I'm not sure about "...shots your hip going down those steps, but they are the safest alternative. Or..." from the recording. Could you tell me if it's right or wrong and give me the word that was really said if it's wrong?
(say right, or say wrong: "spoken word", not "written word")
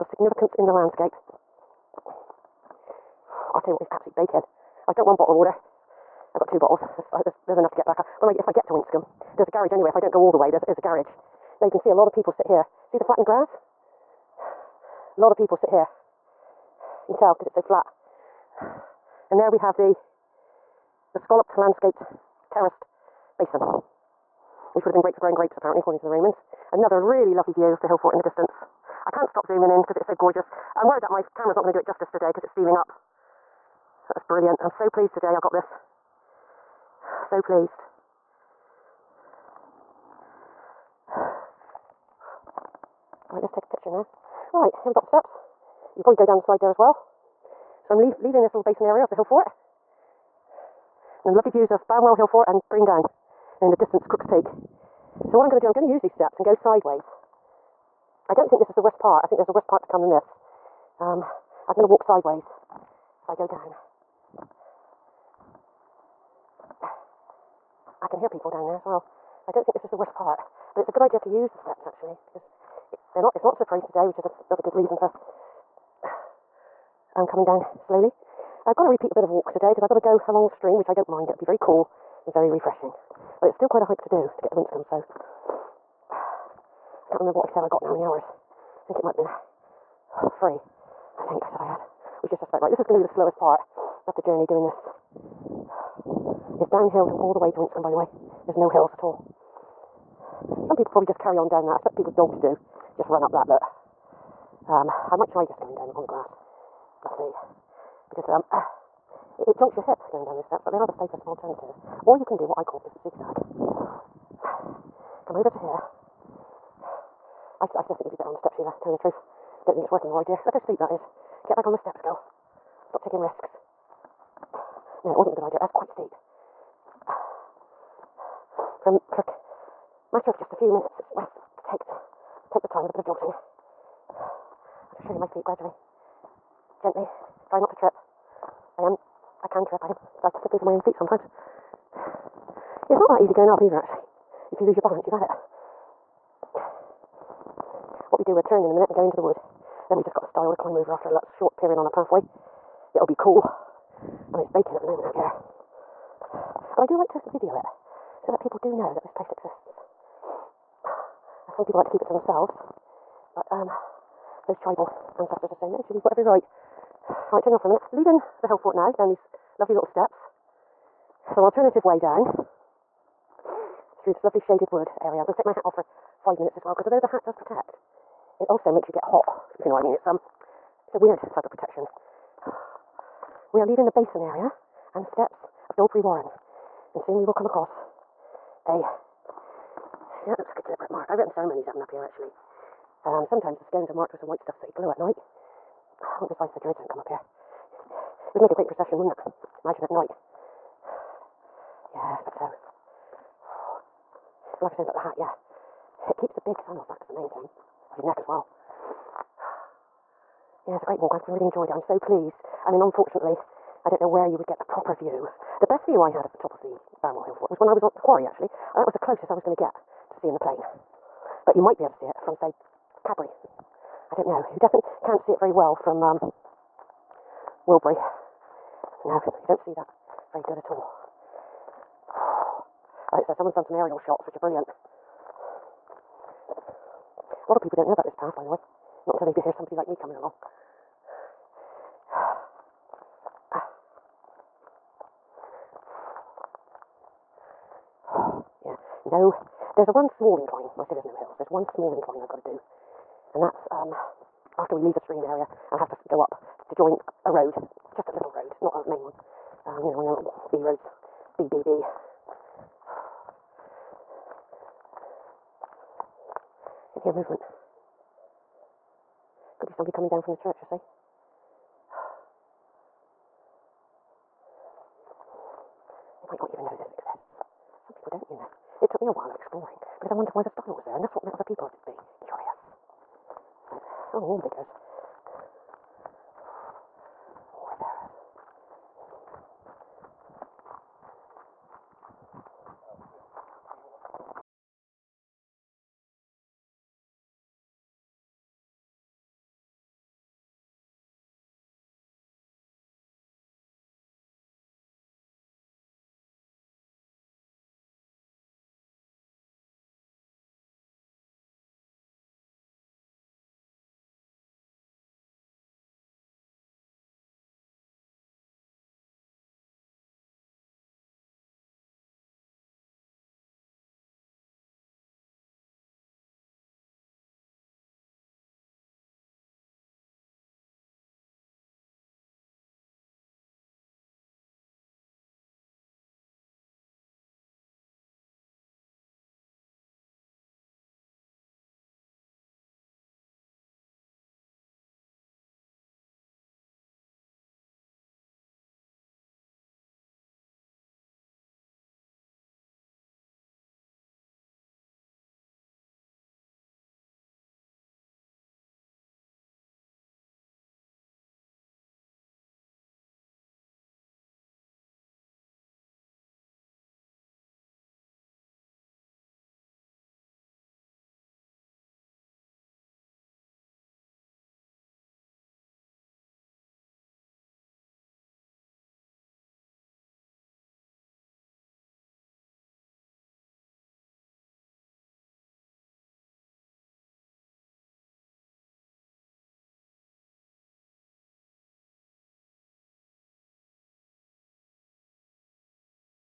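wrong: "jolts", not "shots".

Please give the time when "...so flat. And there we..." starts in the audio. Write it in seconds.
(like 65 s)
17 s.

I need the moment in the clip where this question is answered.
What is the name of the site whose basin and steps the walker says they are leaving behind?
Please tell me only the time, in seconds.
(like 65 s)
185 s.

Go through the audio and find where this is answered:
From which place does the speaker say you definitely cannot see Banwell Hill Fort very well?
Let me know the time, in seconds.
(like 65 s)
227 s.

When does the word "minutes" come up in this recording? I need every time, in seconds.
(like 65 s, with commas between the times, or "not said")
130 s, 148 s, 167 s, 176 s.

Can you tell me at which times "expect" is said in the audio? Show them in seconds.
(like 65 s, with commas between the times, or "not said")
101 s, 202 s.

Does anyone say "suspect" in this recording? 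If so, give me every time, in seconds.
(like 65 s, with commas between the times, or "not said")
92 s.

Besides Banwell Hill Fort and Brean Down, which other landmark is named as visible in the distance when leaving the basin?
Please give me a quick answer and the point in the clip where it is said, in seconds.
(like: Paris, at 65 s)
Crooks Peak, at 54 s.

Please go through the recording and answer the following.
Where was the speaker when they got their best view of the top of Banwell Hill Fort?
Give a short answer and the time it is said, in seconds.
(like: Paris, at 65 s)
The quarry, at 217 s.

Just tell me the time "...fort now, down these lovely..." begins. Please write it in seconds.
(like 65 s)
168 s.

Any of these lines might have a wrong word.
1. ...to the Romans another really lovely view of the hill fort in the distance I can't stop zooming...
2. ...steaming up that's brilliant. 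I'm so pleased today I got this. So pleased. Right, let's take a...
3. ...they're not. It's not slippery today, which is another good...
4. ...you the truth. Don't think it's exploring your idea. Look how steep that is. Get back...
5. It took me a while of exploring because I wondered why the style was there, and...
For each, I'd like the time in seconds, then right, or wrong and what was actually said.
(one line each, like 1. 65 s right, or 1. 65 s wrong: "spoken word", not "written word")
1. 25 s right
2. 32 s right
3. 73 s right
4. 118 s wrong: "working", not "exploring"
5. 278 s right.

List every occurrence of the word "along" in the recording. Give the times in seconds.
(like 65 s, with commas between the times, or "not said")
80 s, 240 s.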